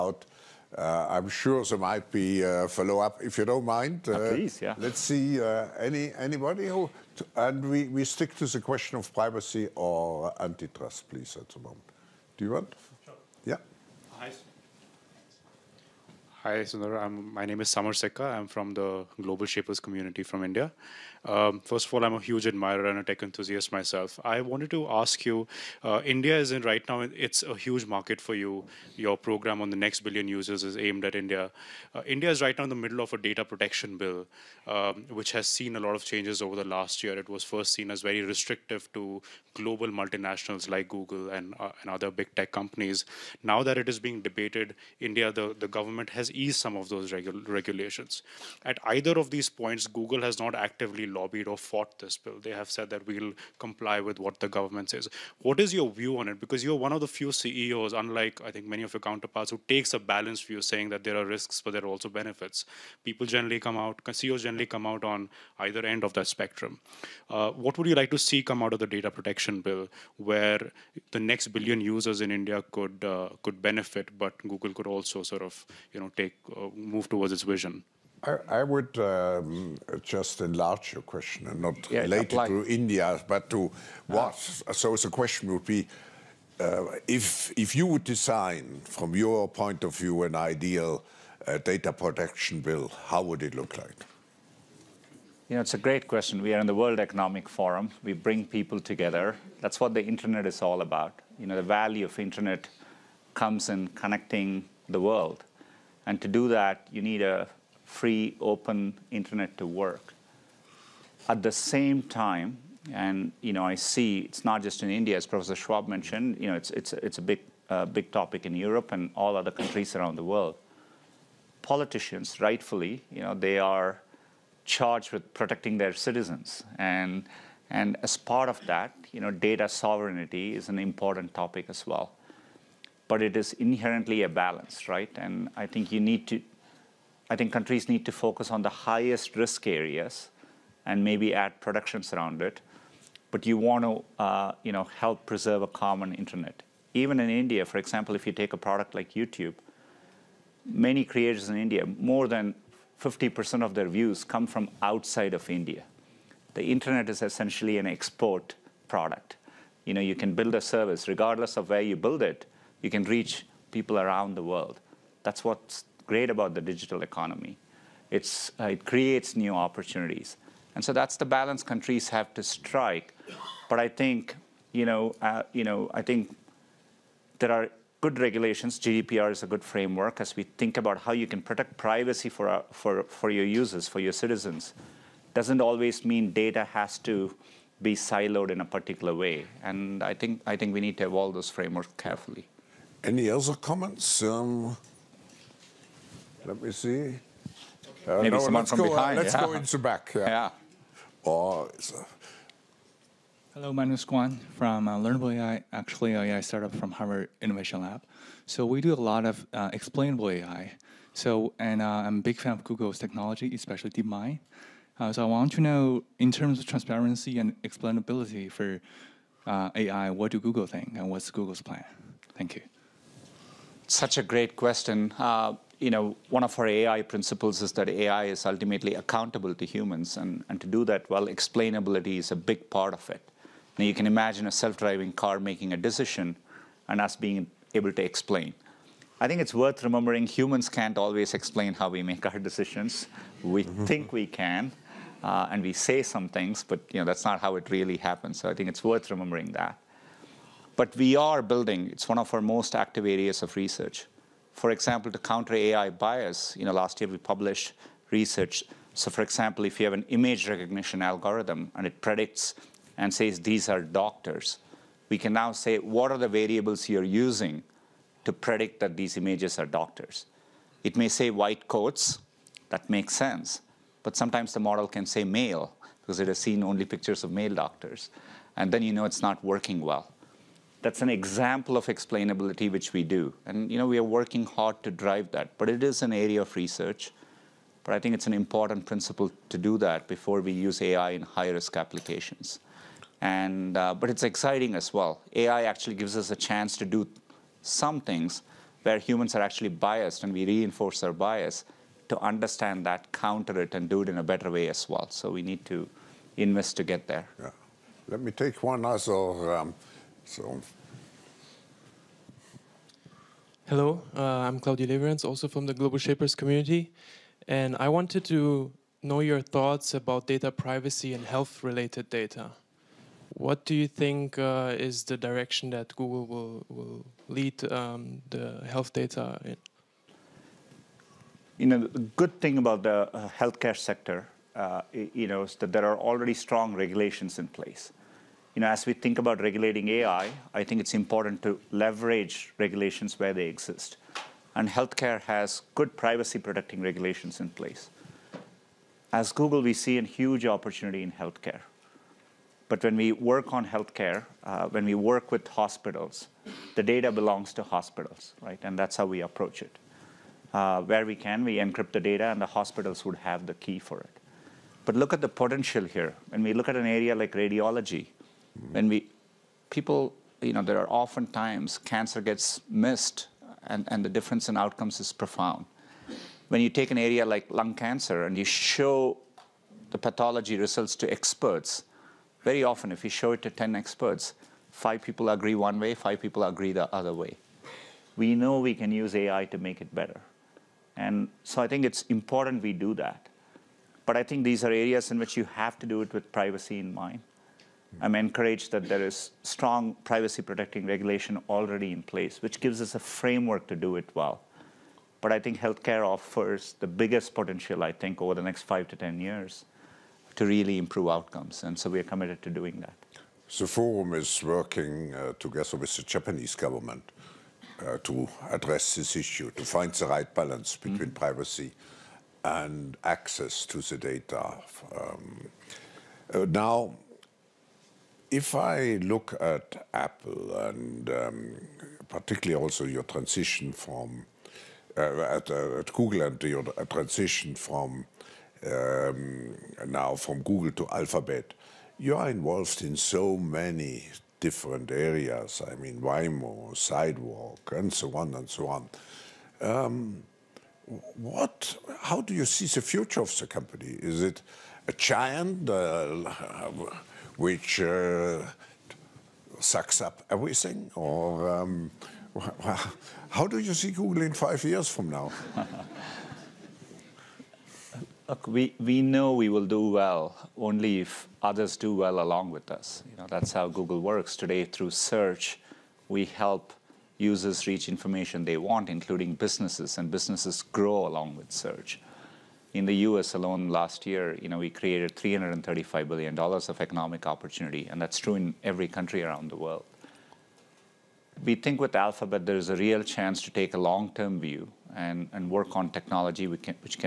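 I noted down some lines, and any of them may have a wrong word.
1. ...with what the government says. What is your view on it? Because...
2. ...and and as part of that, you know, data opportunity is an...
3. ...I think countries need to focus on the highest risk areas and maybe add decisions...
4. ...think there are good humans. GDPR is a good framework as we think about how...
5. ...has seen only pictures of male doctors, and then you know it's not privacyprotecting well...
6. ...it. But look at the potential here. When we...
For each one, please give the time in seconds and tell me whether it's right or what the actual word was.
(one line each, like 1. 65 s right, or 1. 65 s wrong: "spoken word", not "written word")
1. 53 s right
2. 126 s wrong: "sovereignty", not "opportunity"
3. 137 s wrong: "protections", not "decisions"
4. 176 s wrong: "regulations", not "humans"
5. 276 s wrong: "working", not "privacyprotecting"
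6. 363 s right.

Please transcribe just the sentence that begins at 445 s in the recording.
I mean, Waymo, Sidewalk, and so on and so on.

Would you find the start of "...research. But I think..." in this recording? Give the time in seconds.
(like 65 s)
286 s.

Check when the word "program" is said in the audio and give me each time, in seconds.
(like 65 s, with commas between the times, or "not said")
29 s.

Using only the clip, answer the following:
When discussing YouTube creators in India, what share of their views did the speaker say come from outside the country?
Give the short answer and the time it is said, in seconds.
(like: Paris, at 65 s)
more than 50%, at 151 s.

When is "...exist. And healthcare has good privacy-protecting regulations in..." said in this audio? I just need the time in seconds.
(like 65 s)
343 s.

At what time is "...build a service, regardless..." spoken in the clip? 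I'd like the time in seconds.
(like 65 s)
160 s.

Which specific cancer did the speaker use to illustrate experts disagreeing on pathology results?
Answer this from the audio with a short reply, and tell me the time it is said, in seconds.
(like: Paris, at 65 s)
lung cancer, at 377 s.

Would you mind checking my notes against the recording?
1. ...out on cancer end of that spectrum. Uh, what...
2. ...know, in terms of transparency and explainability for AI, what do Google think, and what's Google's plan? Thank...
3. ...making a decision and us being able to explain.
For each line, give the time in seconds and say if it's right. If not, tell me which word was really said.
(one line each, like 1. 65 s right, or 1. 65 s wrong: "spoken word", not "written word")
1. 64 s wrong: "either", not "cancer"
2. 215 s right
3. 235 s right.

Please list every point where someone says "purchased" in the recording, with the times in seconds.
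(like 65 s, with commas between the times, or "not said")
not said.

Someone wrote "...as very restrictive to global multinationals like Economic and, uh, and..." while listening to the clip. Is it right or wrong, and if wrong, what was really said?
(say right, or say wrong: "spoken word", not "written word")
wrong: "Google", not "Economic".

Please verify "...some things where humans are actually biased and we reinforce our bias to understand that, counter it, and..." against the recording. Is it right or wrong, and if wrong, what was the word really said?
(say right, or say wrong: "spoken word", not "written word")
right.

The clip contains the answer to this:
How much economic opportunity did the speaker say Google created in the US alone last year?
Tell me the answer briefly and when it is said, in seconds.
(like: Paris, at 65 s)
$335 billion, at 485 s.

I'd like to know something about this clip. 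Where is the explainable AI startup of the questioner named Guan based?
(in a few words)
Harvard Innovation Lab.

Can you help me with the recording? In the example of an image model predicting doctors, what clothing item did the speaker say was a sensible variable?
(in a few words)
white coats.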